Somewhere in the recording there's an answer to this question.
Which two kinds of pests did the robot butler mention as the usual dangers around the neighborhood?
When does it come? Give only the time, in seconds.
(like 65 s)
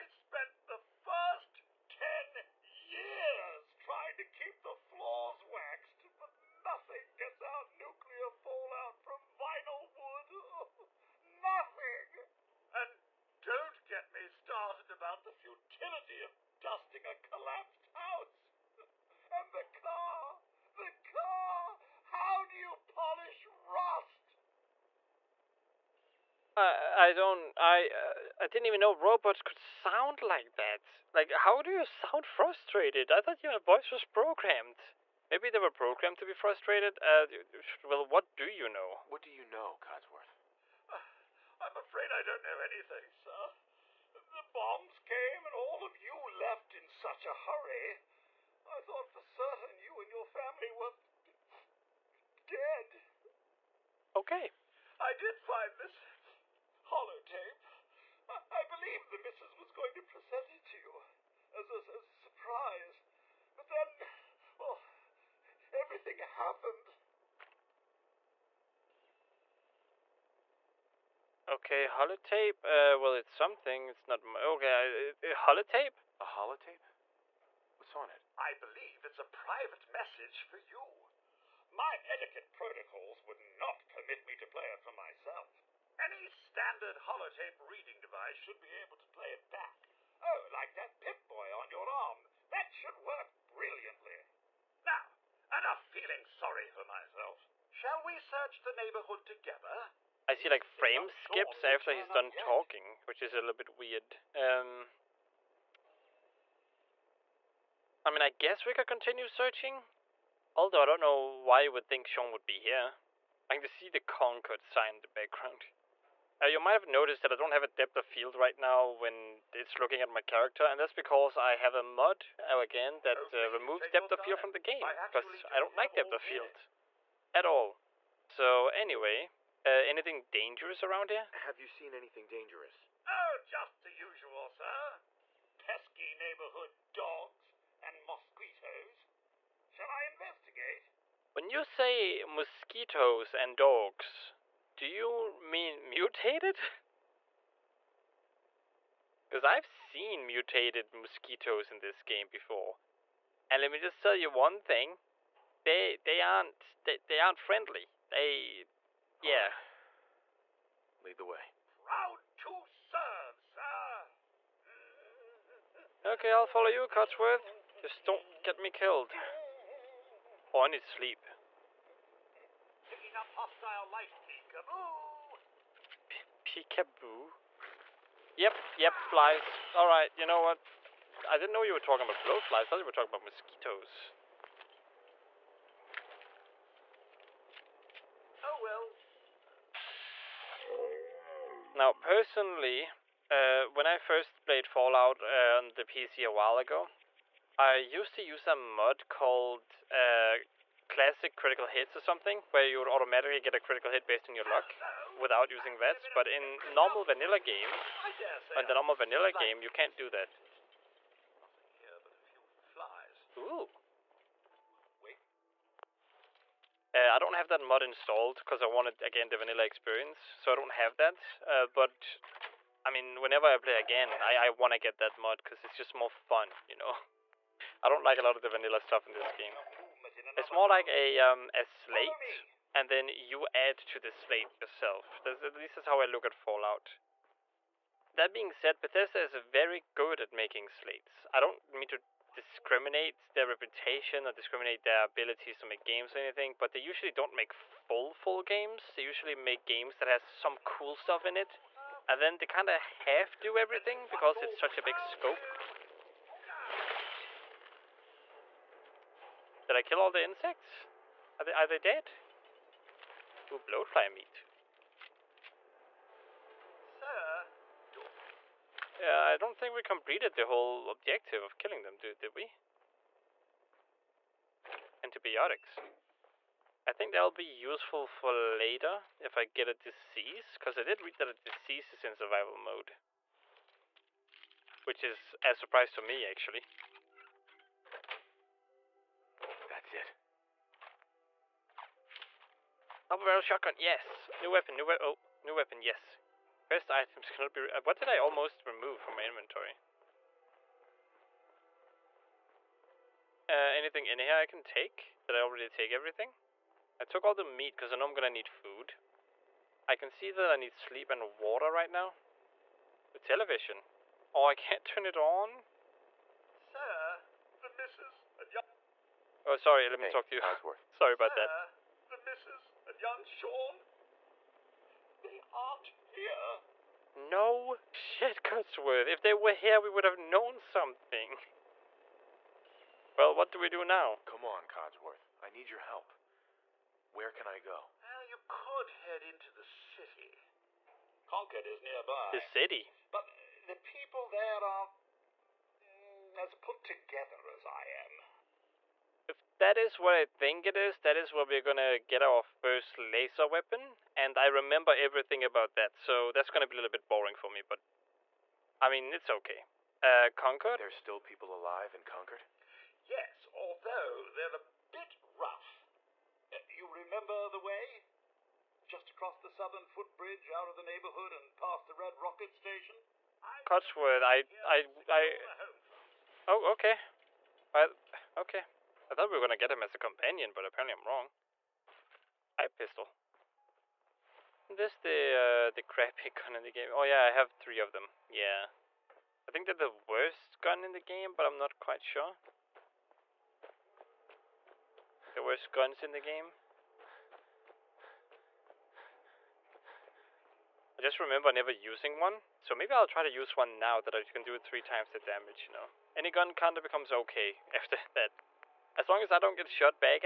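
136 s.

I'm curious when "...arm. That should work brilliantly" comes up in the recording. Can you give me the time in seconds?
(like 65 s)
91 s.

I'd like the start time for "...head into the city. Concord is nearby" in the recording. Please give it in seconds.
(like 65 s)
339 s.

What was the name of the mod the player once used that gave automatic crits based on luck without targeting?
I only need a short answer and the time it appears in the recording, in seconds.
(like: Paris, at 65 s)
Classic Critical Hits, at 200 s.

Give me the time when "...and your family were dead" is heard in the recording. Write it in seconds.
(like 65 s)
50 s.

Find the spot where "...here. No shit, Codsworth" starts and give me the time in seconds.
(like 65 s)
326 s.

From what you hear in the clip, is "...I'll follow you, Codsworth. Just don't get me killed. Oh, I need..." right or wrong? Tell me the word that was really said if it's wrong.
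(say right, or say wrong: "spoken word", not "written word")
right.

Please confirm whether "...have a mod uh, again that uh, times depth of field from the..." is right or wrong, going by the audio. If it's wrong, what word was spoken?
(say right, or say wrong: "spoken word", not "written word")
wrong: "removes", not "times".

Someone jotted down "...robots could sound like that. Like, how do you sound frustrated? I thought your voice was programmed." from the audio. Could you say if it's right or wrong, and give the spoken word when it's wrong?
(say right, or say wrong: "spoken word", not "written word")
right.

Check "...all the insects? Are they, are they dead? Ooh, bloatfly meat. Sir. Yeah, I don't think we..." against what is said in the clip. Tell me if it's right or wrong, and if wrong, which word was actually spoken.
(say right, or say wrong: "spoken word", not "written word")
right.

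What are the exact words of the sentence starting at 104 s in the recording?
Um, I mean, I guess we could continue searching.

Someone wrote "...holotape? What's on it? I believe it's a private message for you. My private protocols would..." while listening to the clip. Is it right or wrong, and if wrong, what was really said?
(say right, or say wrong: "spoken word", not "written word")
wrong: "etiquette", not "private".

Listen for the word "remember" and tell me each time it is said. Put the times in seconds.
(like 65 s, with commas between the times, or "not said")
354 s, 366 s, 401 s.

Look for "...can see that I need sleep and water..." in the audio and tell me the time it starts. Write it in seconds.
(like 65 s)
309 s.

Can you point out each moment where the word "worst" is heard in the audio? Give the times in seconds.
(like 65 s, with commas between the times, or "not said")
389 s, 395 s.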